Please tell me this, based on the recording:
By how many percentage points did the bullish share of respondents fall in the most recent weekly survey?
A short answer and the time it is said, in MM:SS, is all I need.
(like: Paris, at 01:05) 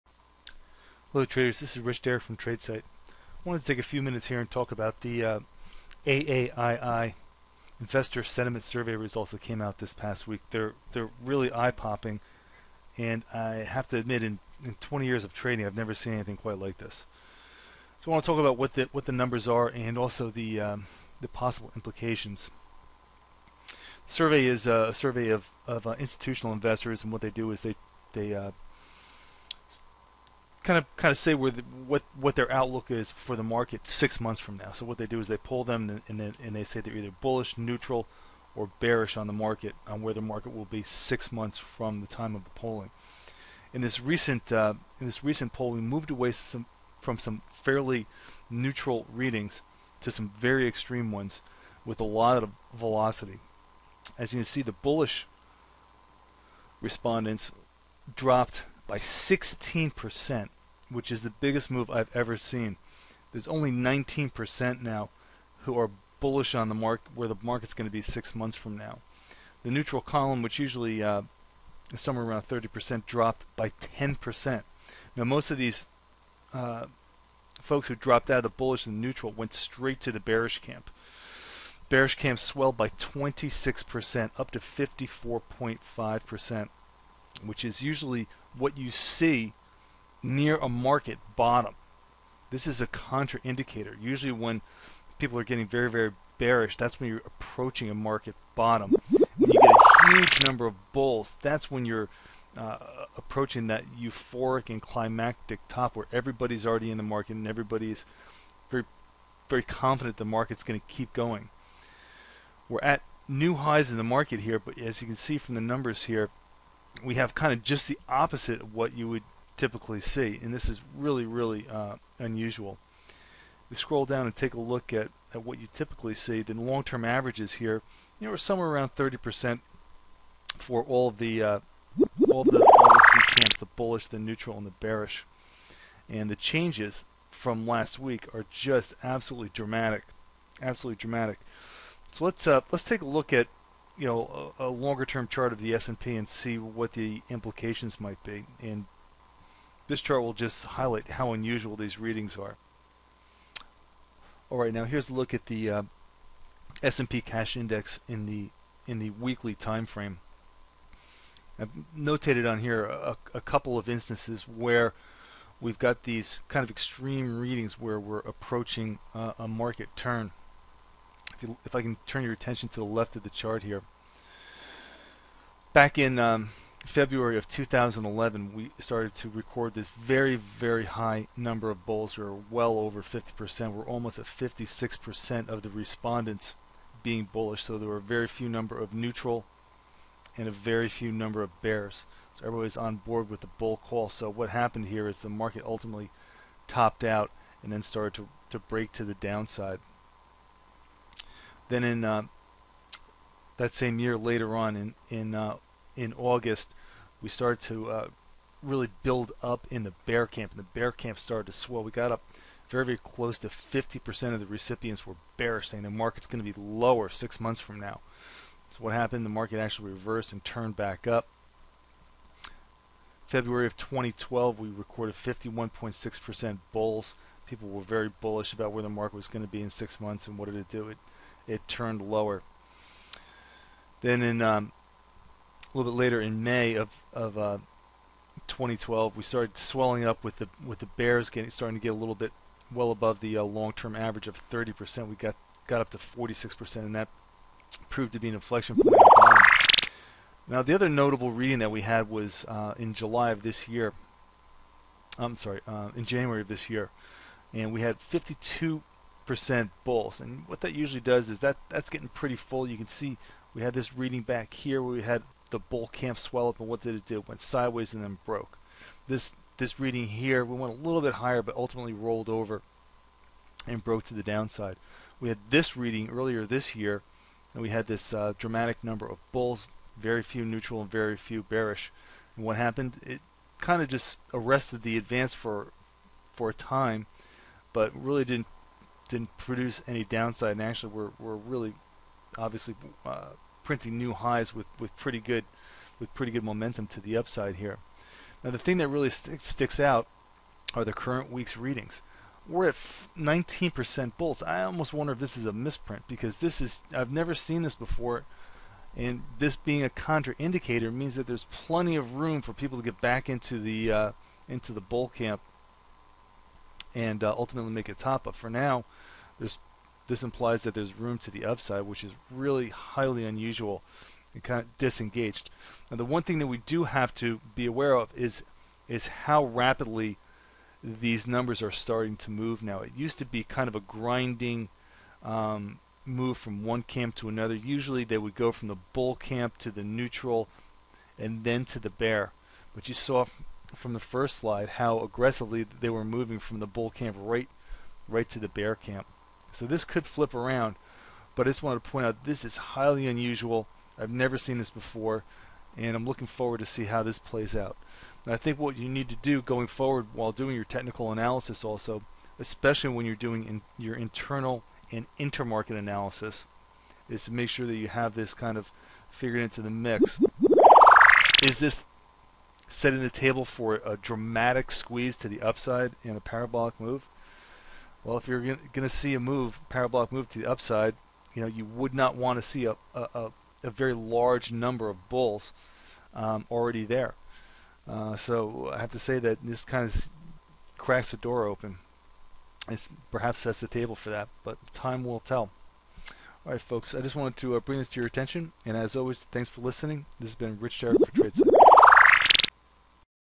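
16%, at 00:58.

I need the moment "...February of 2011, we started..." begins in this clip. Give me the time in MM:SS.
02:56.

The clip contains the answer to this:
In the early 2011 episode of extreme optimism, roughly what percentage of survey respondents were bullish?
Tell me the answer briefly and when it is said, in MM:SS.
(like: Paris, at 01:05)
56%, at 03:04.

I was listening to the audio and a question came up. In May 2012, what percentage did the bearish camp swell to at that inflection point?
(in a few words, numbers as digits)
46%.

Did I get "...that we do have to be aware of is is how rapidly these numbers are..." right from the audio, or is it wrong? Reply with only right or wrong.
right.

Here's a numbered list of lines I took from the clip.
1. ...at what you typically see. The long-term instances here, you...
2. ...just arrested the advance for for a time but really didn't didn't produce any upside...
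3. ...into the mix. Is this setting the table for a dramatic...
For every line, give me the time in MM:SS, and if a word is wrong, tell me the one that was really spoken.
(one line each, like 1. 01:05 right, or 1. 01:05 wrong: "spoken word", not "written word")
1. 02:05 wrong: "averages", not "instances"
2. 04:43 wrong: "downside", not "upside"
3. 06:09 right.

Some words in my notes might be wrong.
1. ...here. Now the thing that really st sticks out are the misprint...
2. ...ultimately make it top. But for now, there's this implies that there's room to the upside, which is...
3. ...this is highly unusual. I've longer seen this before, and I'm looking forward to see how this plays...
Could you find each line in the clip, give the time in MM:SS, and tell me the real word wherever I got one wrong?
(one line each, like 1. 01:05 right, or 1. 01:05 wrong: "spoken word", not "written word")
1. 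04:57 wrong: "current", not "misprint"
2. 05:17 right
3. 05:52 wrong: "never", not "longer".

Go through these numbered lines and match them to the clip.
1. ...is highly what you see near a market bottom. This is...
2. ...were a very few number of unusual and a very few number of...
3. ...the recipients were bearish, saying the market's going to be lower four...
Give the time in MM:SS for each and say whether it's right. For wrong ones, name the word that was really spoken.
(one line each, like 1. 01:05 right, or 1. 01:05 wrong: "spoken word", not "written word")
1. 01:27 wrong: "usually", not "highly"
2. 03:07 wrong: "neutral", not "unusual"
3. 03:34 wrong: "six", not "four".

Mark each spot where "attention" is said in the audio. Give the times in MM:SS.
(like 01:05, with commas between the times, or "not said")
02:52, 06:38.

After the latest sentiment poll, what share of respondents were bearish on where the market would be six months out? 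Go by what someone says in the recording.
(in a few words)
54.5%.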